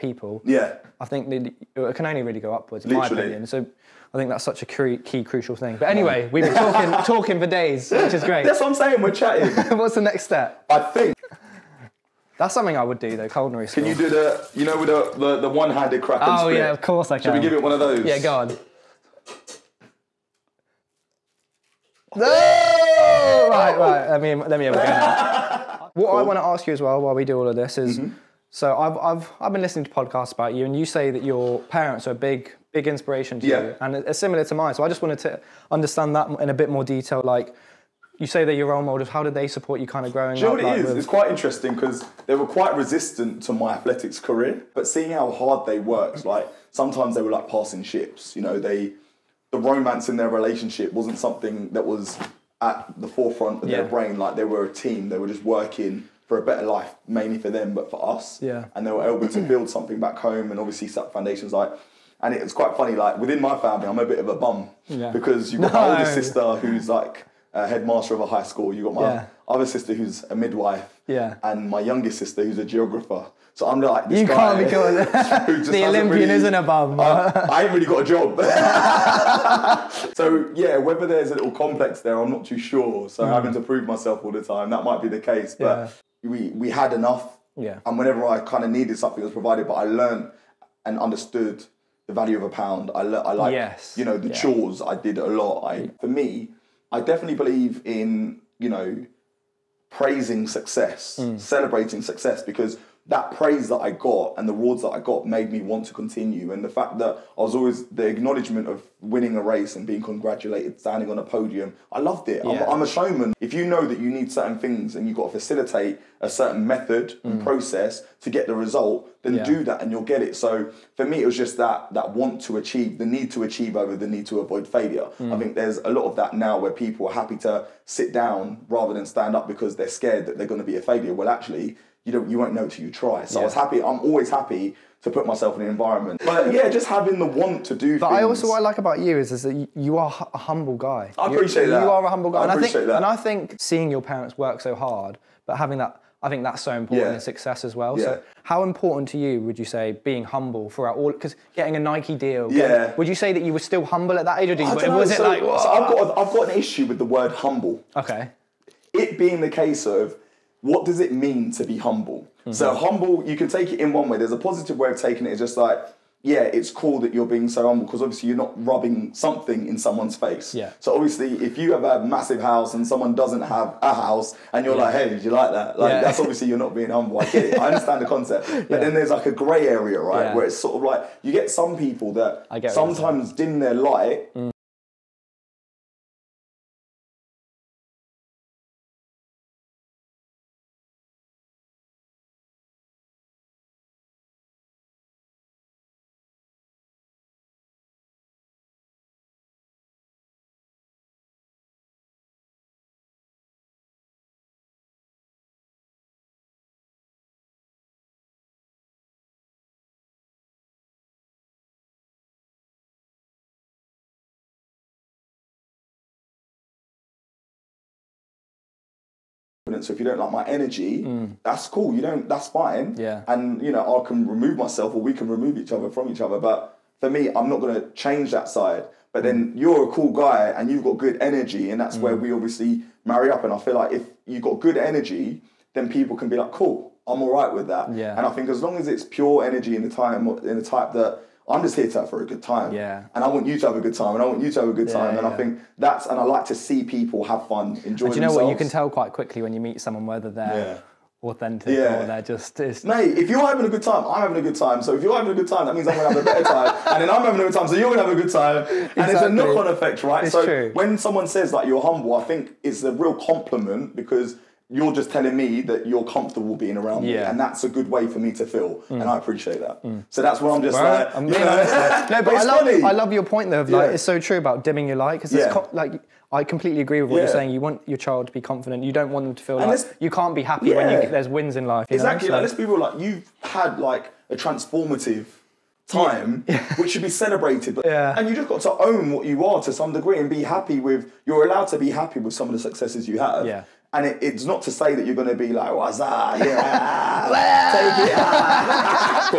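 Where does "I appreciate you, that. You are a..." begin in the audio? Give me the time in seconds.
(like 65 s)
141 s.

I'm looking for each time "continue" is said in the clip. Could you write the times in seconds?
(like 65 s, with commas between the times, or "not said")
105 s.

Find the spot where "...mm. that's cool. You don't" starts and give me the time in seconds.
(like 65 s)
221 s.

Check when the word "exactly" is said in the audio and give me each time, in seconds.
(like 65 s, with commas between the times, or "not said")
258 s, 281 s.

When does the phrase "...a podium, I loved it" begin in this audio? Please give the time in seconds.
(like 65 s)
111 s.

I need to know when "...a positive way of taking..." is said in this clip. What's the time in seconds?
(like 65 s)
164 s.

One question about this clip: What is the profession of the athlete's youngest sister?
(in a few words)
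geographer.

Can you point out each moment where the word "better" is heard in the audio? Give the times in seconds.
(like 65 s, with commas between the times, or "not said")
56 s, 256 s.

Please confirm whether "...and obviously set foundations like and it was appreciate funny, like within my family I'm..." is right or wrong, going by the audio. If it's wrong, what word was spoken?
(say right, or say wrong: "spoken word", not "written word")
wrong: "quite", not "appreciate".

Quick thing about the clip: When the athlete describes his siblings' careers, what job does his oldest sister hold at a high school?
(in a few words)
headmaster.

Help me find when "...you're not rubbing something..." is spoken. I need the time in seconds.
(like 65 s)
168 s.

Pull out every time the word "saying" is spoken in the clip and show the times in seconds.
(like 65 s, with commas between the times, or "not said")
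8 s, 277 s.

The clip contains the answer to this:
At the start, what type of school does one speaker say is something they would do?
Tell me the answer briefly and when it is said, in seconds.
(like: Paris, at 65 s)
culinary school, at 13 s.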